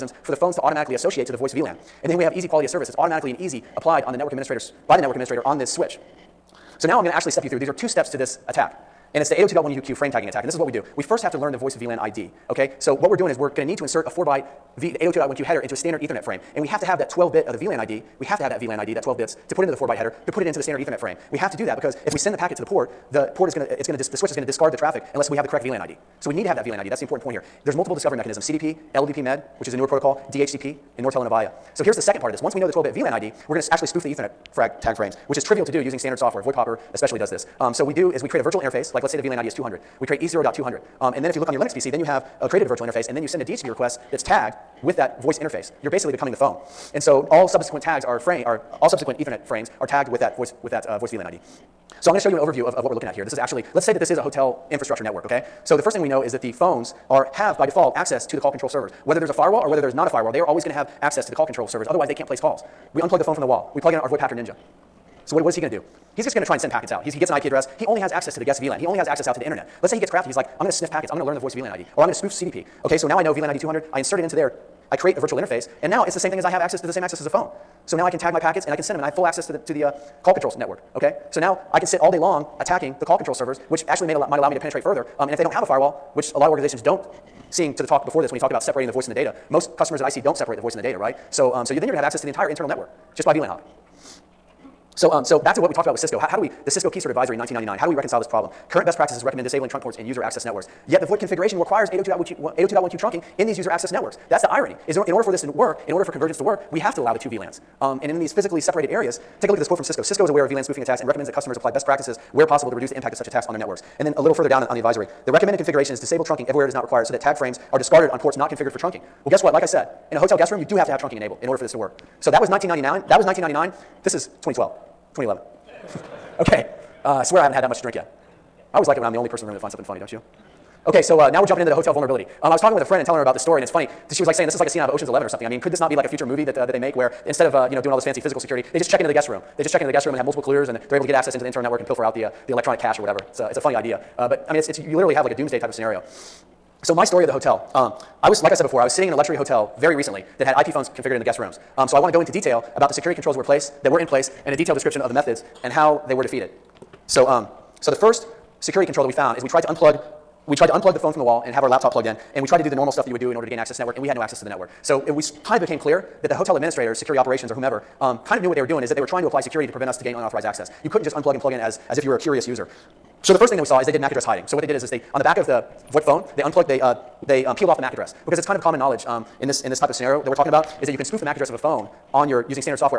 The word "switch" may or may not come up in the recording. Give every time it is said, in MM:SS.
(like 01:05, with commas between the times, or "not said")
00:05, 00:24.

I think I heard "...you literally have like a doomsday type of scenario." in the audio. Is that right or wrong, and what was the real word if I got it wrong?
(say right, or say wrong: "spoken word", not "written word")
right.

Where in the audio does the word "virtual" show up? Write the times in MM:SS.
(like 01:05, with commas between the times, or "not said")
00:38, 00:42, 01:15.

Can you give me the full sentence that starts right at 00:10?
We first have to learn the voice VLAN ID.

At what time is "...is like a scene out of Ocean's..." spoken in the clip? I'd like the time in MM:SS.
02:14.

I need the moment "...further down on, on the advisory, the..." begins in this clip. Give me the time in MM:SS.
01:54.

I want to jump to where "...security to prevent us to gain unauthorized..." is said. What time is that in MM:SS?
02:49.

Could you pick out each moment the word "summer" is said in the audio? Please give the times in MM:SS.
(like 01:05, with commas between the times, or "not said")
not said.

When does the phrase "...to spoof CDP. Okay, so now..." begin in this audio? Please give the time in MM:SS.
01:12.